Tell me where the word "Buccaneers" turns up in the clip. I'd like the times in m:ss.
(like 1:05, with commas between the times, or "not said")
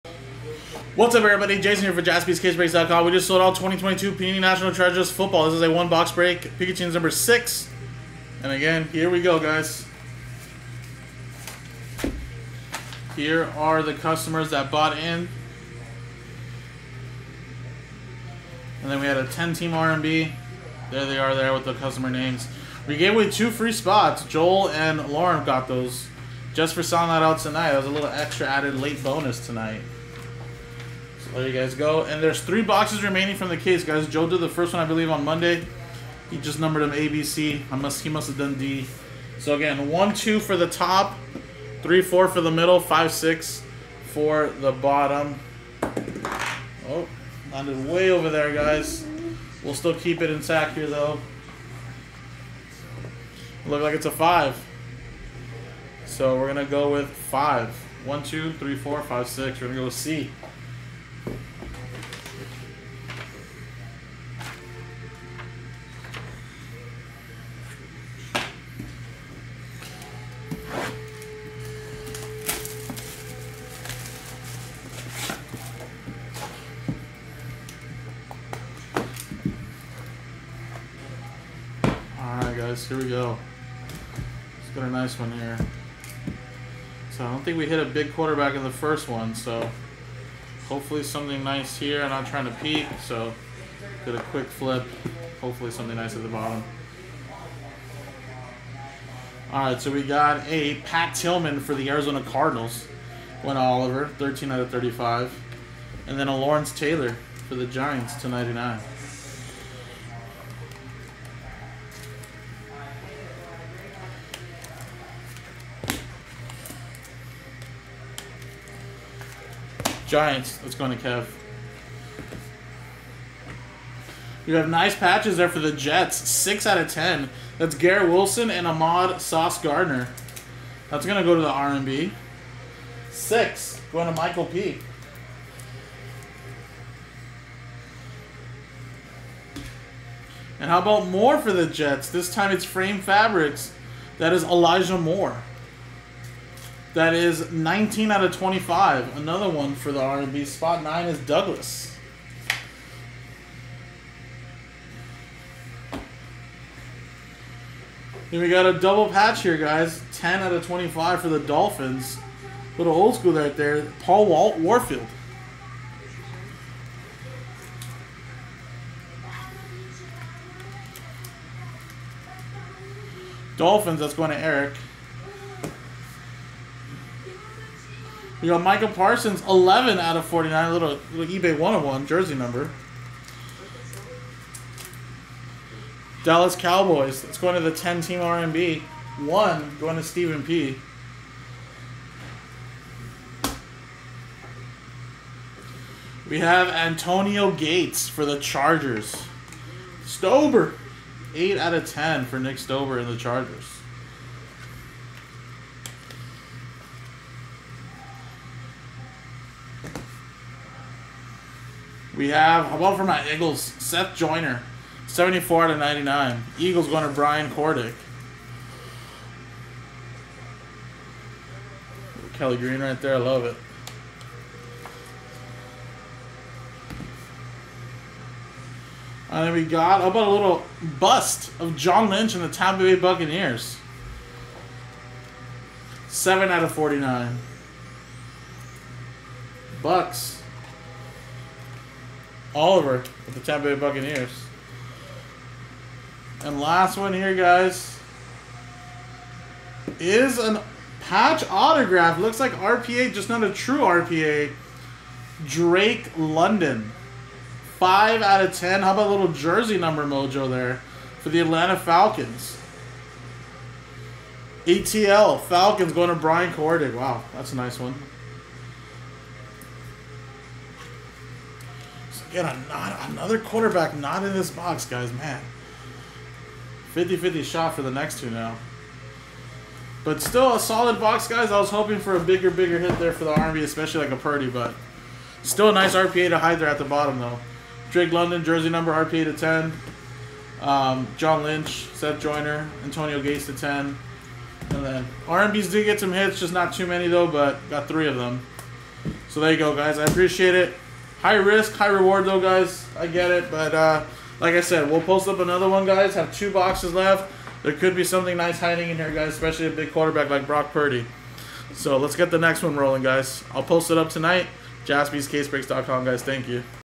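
3:52, 4:03.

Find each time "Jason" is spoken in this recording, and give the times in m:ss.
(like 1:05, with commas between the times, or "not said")
0:01.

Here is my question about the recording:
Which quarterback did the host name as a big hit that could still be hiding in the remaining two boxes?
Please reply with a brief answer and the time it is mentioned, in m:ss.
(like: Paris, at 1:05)
Brock Purdy, at 5:10.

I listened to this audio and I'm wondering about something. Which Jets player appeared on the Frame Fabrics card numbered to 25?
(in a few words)
Elijah Moore.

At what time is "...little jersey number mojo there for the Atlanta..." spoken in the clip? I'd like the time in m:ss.
4:19.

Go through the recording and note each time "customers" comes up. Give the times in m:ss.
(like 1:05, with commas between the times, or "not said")
0:13, 0:21.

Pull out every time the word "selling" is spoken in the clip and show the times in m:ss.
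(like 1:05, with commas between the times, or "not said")
0:26.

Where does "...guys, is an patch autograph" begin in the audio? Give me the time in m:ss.
4:07.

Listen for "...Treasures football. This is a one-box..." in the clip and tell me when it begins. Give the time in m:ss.
0:04.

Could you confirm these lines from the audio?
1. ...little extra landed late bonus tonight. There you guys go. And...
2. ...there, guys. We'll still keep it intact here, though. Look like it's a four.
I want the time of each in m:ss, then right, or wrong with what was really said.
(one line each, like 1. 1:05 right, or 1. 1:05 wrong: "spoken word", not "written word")
1. 0:27 wrong: "added", not "landed"
2. 0:48 wrong: "five", not "four".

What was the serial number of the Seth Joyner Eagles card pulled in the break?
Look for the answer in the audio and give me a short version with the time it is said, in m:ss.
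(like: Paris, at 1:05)
74/99, at 3:35.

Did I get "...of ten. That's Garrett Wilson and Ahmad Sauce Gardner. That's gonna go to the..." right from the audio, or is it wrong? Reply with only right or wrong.
right.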